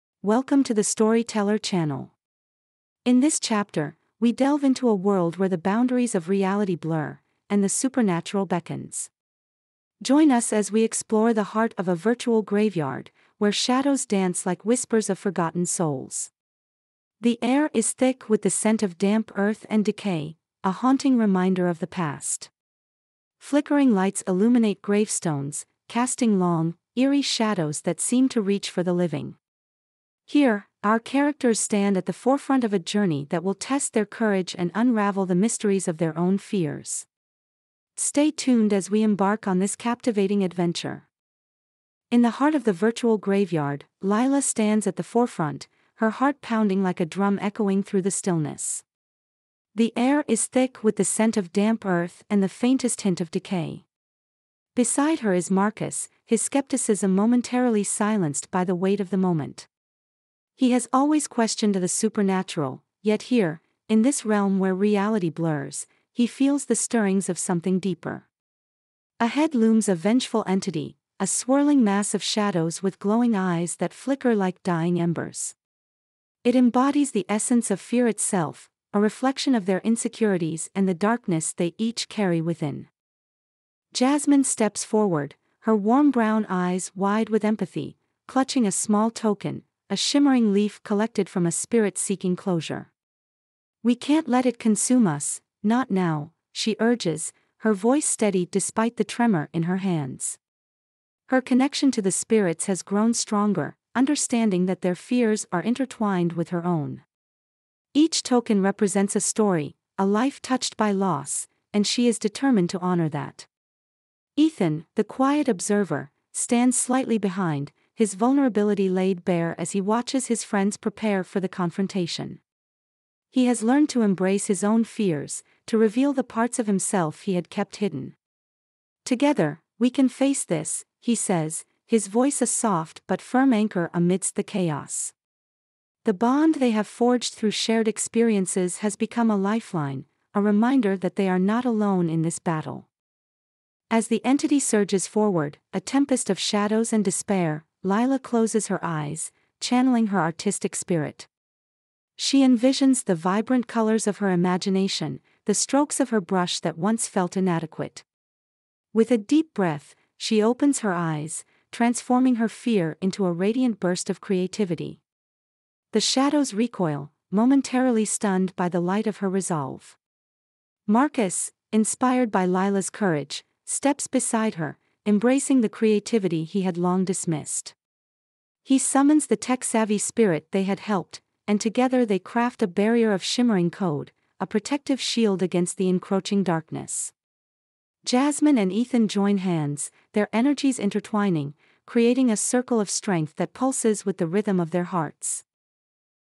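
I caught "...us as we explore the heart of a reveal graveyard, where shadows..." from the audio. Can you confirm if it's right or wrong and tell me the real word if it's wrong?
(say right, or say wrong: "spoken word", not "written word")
wrong: "virtual", not "reveal".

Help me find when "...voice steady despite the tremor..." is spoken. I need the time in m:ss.
1:37.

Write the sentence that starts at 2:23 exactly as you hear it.
As the entity surges forward, a tempest of shadows and despair, Lila closes her eyes, channeling her artistic spirit.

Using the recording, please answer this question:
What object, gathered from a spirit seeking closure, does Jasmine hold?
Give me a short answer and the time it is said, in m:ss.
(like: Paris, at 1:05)
A shimmering leaf, at 1:29.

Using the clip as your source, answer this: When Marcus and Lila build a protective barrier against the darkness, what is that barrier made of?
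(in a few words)
Shimmering code.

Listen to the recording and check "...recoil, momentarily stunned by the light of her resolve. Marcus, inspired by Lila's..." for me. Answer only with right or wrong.
right.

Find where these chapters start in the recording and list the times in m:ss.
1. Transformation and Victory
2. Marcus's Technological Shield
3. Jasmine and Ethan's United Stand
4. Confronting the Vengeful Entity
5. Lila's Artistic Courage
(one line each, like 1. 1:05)
1. 2:30
2. 1:30
3. 2:00
4. 0:30
5. 1:00.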